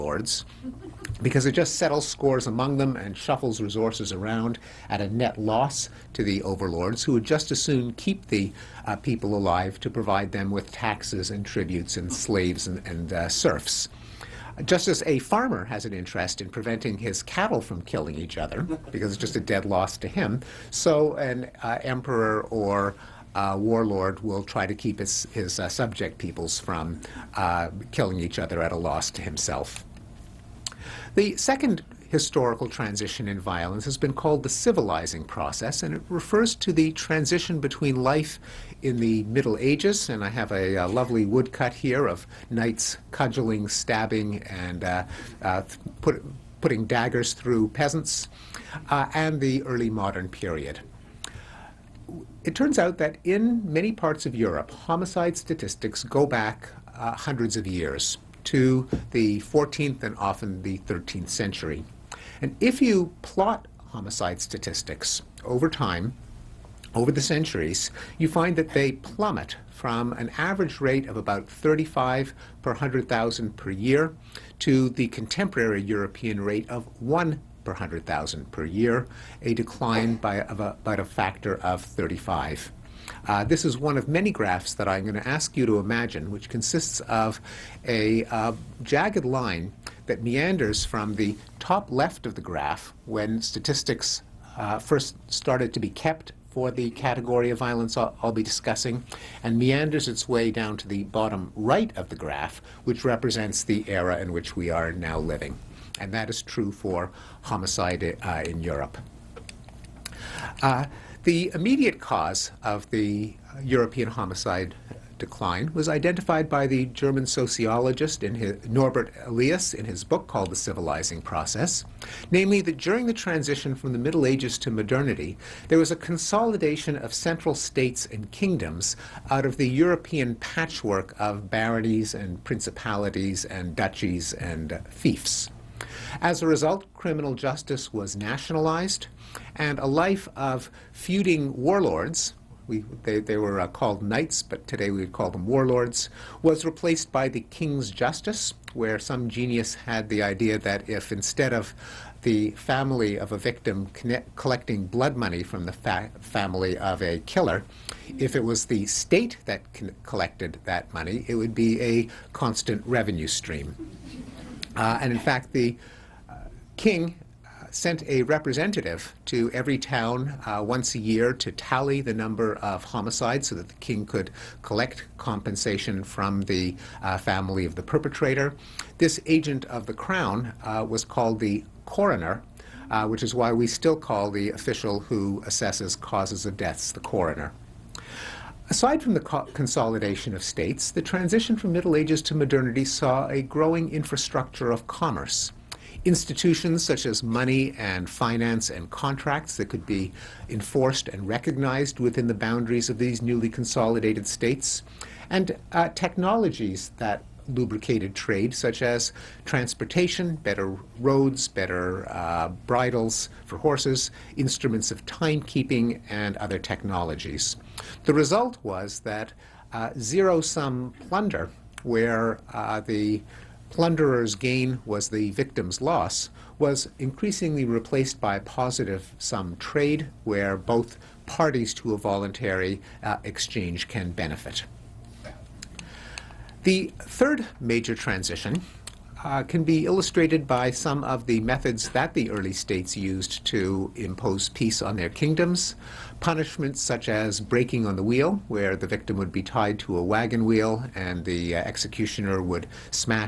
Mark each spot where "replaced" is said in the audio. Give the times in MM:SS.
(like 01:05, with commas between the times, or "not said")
02:26, 03:47.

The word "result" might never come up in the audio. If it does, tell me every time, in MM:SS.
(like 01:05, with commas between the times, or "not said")
02:16, 03:38.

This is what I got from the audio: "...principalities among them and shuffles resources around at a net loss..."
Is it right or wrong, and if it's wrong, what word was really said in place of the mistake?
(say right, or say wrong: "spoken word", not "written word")
wrong: "scores", not "principalities".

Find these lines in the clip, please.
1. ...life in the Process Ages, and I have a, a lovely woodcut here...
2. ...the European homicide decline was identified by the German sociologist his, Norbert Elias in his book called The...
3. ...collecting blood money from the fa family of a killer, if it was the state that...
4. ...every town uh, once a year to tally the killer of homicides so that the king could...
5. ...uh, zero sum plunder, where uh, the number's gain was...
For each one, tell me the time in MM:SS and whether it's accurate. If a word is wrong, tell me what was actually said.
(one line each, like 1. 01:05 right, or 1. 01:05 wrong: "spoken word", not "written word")
1. 00:37 wrong: "Middle", not "Process"
2. 01:52 right
3. 02:34 right
4. 02:49 wrong: "number", not "killer"
5. 03:39 wrong: "plunderer", not "number".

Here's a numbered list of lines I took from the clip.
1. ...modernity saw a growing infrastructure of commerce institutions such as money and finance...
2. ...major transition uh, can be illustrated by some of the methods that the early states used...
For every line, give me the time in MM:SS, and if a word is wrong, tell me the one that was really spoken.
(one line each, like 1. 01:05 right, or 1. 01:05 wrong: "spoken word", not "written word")
1. 03:12 right
2. 03:57 right.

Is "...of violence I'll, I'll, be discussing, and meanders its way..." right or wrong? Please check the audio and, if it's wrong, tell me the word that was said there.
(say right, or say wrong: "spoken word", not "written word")
right.